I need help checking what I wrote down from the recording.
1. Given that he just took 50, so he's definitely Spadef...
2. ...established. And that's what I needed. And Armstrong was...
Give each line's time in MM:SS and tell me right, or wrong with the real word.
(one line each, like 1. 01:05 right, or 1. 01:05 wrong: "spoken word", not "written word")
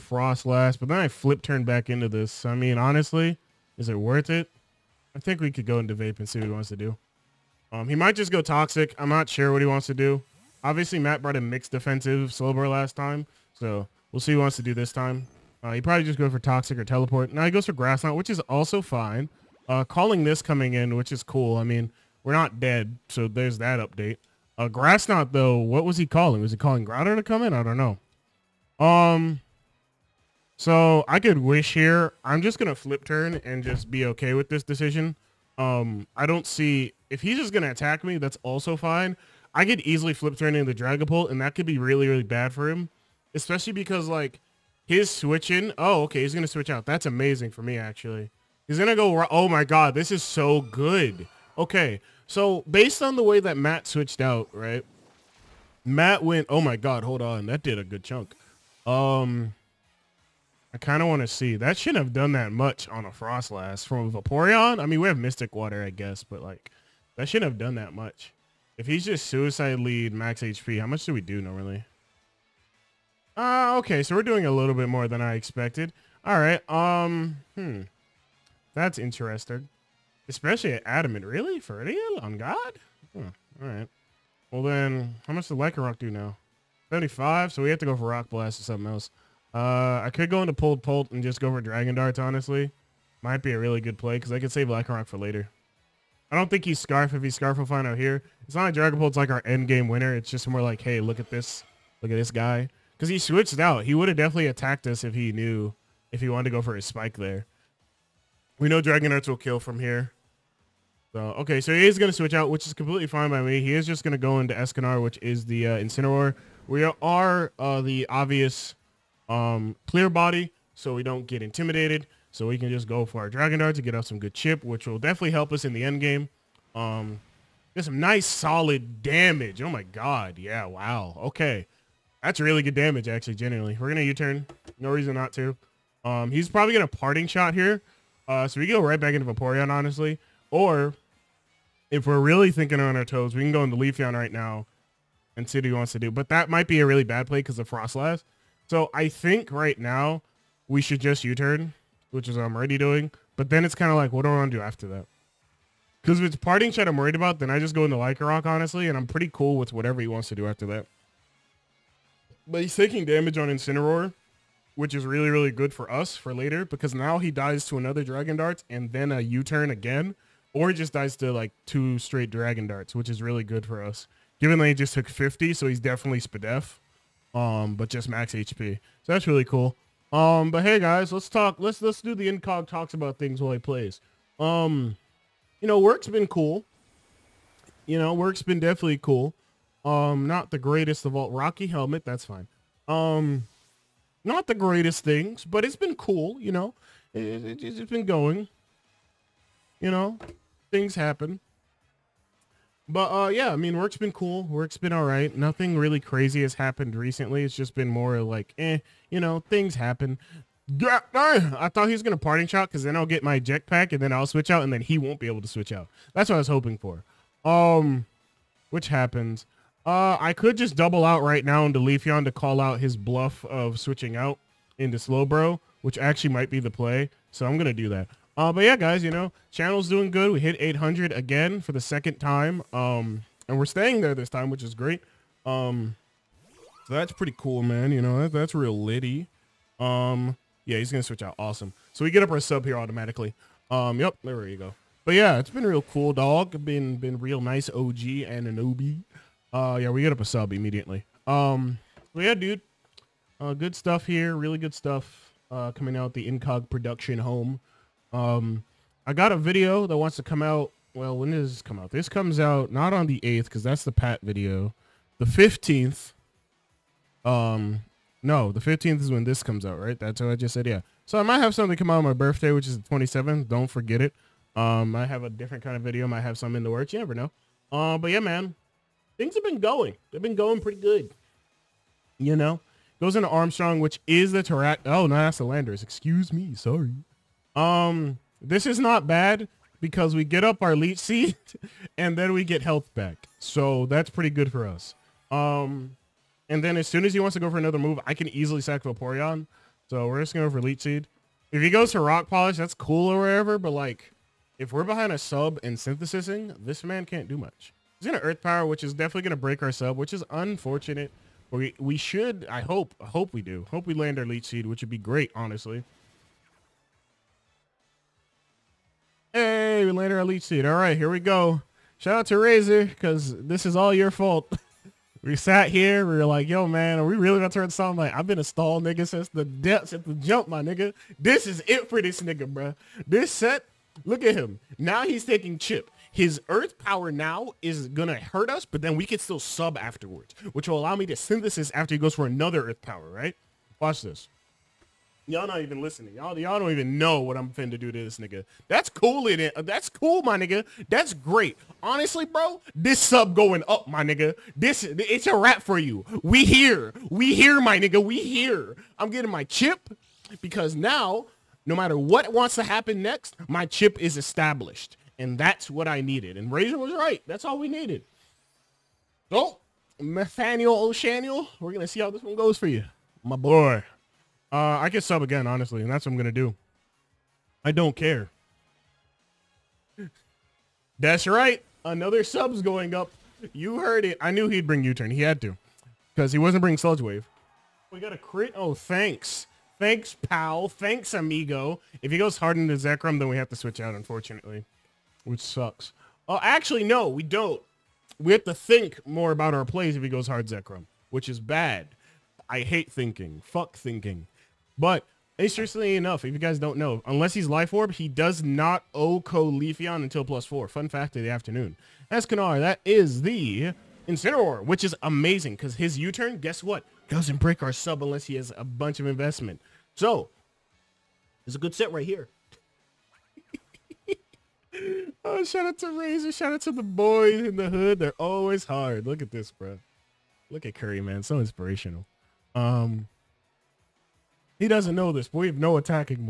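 1. 02:54 right
2. 06:04 wrong: "Razor", not "Armstrong".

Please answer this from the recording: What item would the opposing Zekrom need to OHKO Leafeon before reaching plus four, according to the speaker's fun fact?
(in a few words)
Life Orb.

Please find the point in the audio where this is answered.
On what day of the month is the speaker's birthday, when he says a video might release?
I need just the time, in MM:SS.
04:32.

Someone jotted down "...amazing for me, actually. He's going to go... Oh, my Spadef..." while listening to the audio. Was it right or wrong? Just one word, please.
wrong.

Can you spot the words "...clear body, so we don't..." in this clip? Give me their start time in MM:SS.
01:59.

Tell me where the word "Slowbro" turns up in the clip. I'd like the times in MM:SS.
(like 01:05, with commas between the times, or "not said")
00:12, 03:44.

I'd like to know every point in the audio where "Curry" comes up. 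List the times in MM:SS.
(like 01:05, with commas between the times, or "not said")
07:10.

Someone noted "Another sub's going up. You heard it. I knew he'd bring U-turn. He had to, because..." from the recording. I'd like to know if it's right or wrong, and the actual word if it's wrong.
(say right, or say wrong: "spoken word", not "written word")
right.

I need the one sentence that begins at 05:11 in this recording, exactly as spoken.
We, we should, I hope, I hope we do.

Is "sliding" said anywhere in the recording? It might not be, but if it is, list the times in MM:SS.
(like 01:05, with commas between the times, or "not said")
not said.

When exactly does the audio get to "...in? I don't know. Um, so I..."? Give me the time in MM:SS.
00:27.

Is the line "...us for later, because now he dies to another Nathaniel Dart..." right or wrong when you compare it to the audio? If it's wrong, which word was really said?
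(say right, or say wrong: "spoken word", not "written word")
wrong: "Dragon", not "Nathaniel".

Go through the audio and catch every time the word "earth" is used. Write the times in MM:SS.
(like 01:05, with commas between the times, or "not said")
05:08, 05:36, 05:42.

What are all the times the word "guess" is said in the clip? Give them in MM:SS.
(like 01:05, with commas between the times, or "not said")
01:05, 06:56.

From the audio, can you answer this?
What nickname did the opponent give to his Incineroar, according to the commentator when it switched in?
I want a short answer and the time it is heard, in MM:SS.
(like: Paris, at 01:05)
Escanar, at 01:54.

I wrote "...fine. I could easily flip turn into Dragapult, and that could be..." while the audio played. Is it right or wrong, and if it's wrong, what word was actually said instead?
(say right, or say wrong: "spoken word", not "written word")
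right.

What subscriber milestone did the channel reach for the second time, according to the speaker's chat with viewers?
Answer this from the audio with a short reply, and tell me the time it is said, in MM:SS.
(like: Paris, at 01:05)
800, at 03:50.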